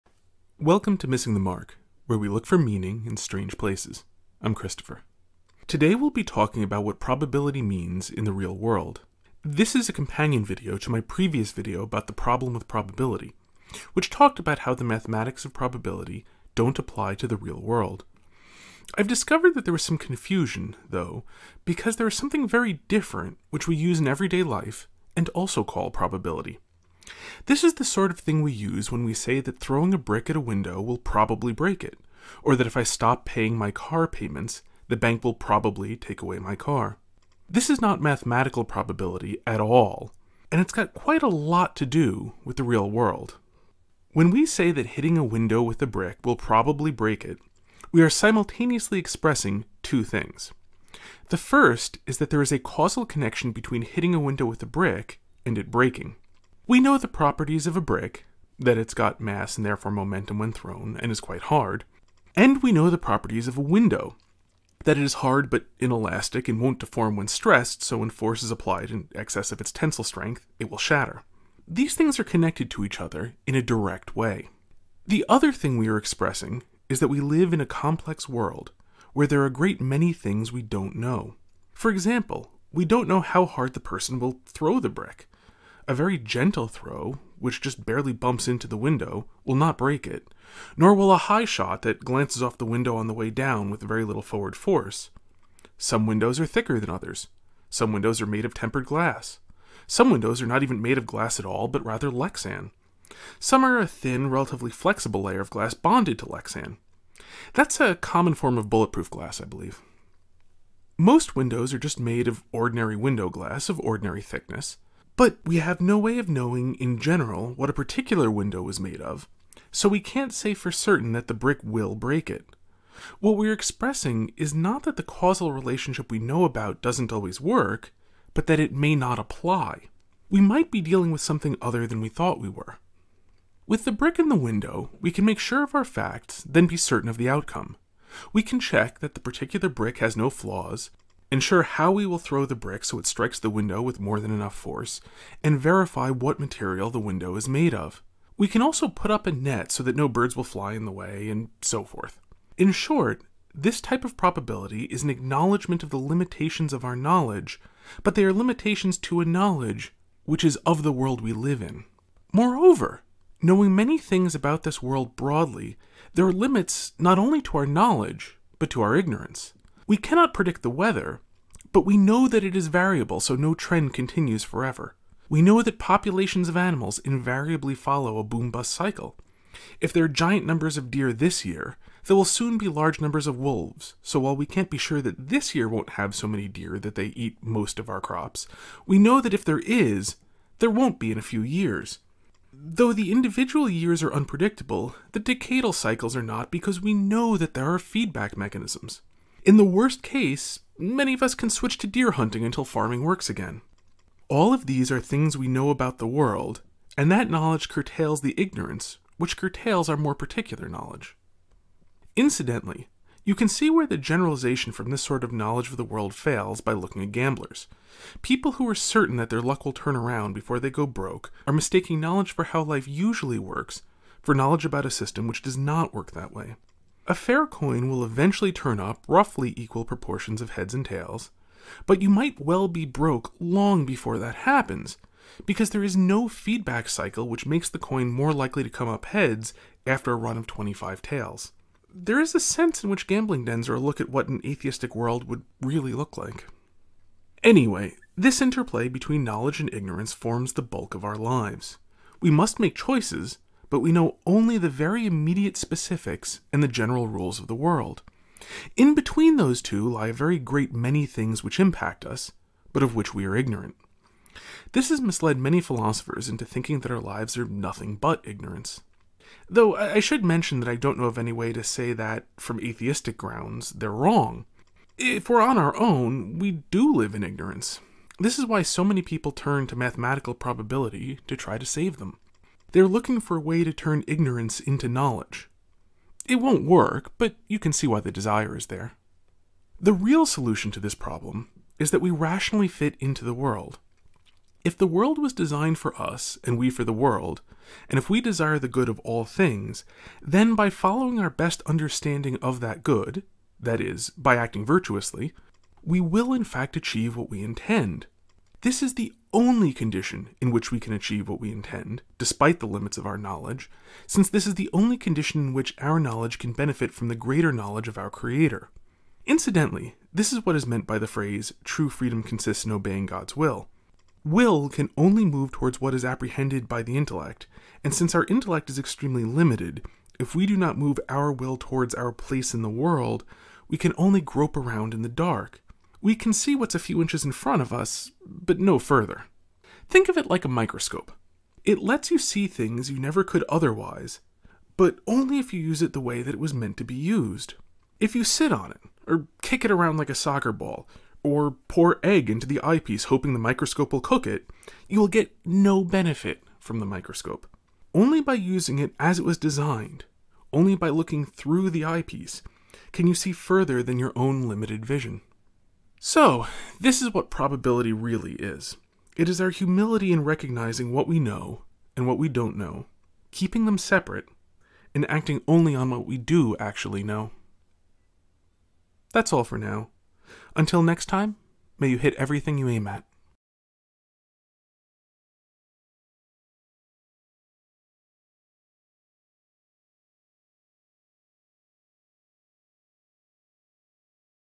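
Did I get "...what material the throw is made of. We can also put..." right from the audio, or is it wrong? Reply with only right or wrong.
wrong.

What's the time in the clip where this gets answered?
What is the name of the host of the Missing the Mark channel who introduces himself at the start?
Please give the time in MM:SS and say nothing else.
00:04.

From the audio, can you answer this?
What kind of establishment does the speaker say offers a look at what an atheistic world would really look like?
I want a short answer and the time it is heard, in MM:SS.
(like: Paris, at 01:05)
gambling dens, at 04:03.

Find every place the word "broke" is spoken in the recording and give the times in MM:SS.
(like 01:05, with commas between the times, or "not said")
03:40, 03:52.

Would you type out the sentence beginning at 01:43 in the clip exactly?
Some are a thin, relatively flexible layer of glass bonded to Lexan.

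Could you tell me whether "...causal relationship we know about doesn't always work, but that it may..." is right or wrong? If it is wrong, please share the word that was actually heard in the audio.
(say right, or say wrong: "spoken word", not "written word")
right.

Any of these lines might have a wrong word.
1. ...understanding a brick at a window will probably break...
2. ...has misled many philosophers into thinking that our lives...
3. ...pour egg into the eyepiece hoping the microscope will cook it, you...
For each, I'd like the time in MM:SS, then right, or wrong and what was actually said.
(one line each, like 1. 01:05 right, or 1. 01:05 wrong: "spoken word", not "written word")
1. 00:29 wrong: "throwing", not "understanding"
2. 04:24 right
3. 05:51 right.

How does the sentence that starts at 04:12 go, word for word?
We must make choices, but we know only the very immediate specifics and the general rules of the world.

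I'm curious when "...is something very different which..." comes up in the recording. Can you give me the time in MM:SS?
00:22.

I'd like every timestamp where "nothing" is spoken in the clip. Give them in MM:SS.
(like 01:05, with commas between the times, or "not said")
04:27.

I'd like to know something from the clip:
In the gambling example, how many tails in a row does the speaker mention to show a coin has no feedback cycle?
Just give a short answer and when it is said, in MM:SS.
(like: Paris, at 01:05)
25, at 04:00.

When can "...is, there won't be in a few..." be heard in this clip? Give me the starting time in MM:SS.
03:09.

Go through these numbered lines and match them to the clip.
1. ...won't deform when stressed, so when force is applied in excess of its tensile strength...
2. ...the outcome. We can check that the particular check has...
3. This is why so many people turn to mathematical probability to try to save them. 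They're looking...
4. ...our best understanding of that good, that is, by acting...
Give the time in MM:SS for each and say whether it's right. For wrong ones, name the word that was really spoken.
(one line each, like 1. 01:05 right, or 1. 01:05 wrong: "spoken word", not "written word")
1. 01:06 right
2. 02:17 wrong: "brick", not "check"
3. 04:38 right
4. 05:01 right.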